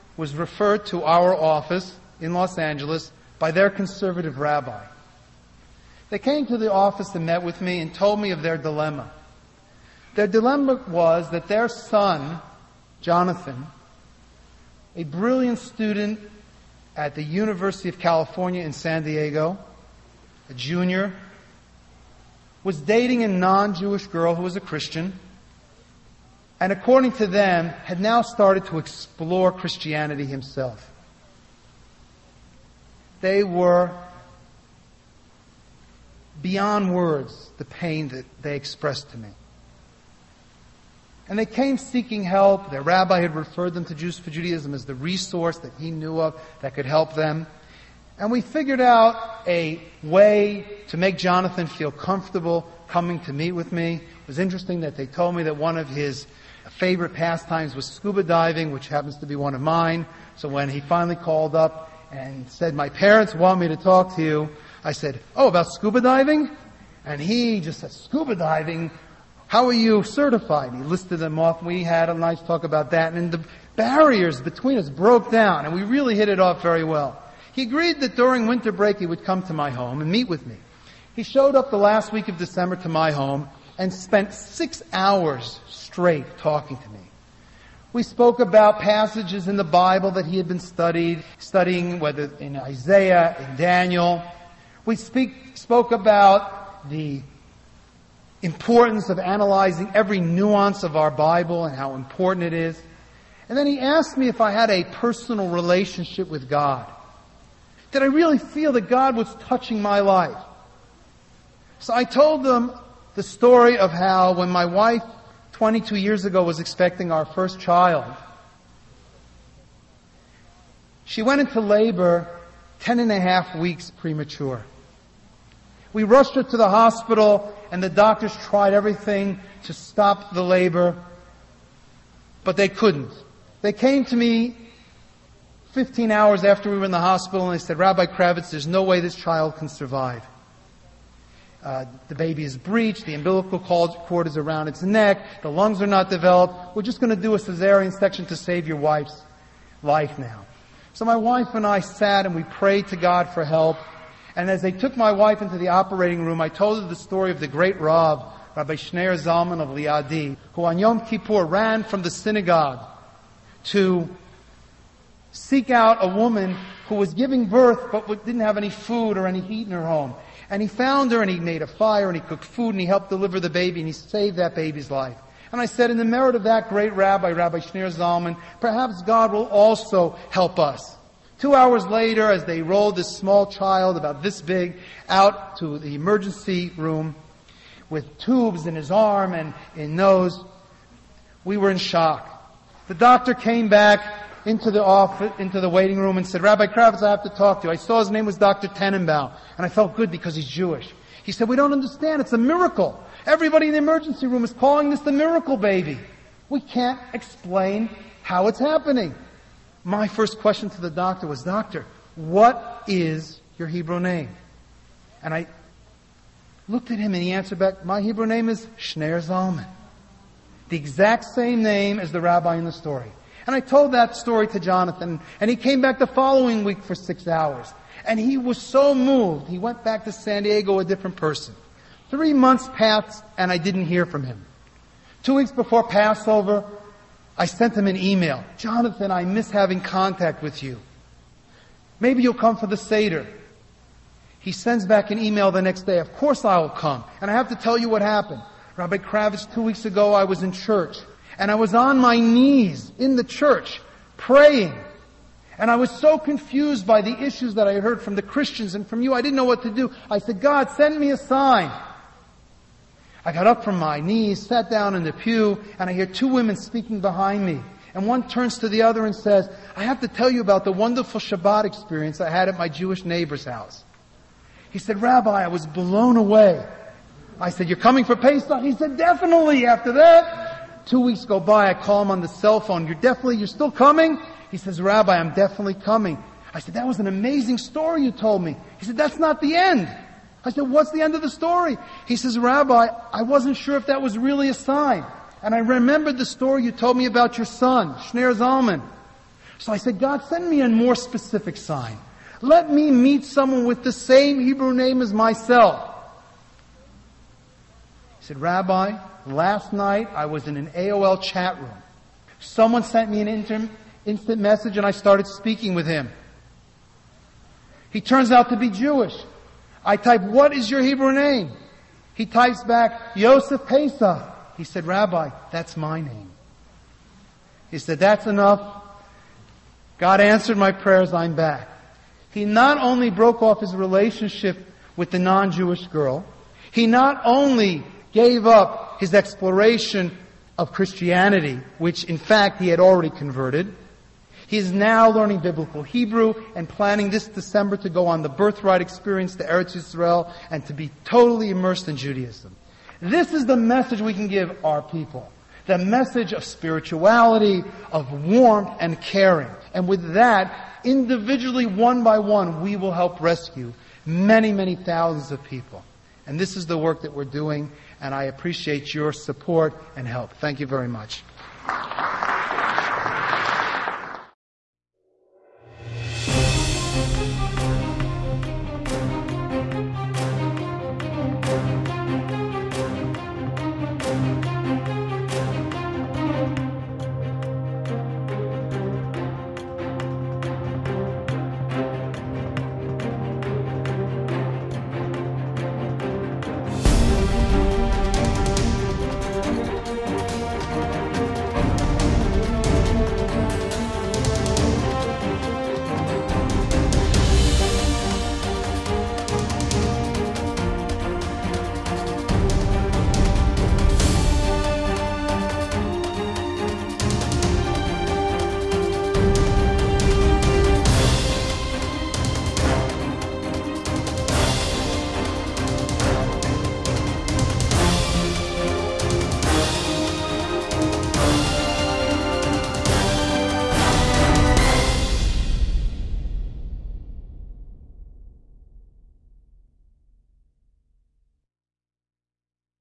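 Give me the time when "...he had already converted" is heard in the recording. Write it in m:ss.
5:42.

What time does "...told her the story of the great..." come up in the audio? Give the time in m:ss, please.
2:36.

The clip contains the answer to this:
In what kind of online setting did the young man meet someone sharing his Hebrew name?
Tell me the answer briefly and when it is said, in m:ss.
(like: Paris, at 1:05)
AOL chat room, at 5:10.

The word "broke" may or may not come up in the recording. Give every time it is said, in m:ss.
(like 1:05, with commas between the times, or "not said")
1:14, 5:33.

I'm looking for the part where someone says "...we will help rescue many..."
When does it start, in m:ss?
6:02.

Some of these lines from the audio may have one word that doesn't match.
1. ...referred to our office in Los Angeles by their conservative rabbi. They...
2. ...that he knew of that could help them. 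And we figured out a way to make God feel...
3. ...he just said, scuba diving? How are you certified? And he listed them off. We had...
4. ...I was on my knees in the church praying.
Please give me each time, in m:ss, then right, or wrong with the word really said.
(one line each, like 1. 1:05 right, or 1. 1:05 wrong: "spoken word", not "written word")
1. 0:00 right
2. 0:45 wrong: "Jonathan", not "God"
3. 1:07 right
4. 4:11 right.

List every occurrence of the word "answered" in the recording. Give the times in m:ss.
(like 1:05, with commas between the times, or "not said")
3:37, 5:30.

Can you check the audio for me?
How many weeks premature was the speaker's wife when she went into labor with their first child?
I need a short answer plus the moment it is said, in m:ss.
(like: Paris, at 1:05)
10 and a half, at 2:02.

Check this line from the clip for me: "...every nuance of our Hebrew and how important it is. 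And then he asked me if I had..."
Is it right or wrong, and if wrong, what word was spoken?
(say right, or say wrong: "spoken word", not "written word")
wrong: "Bible", not "Hebrew".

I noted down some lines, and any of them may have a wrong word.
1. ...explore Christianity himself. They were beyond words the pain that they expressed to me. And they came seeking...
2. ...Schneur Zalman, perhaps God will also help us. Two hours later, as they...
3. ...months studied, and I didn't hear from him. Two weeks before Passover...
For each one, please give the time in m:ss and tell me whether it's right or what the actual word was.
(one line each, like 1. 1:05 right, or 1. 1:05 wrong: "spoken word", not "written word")
1. 0:28 right
2. 2:57 right
3. 3:52 wrong: "passed", not "studied".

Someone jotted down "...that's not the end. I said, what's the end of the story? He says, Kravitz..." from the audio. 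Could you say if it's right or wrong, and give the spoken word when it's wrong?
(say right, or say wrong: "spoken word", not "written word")
wrong: "Rabbi", not "Kravitz".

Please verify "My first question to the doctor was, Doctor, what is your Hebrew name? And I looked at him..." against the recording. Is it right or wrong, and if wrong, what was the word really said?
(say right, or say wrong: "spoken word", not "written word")
right.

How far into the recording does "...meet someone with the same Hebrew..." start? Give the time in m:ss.
5:02.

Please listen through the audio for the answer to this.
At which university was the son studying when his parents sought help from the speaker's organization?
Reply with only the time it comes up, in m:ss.
0:17.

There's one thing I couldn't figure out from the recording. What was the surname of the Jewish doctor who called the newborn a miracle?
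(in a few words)
Tenenbaum.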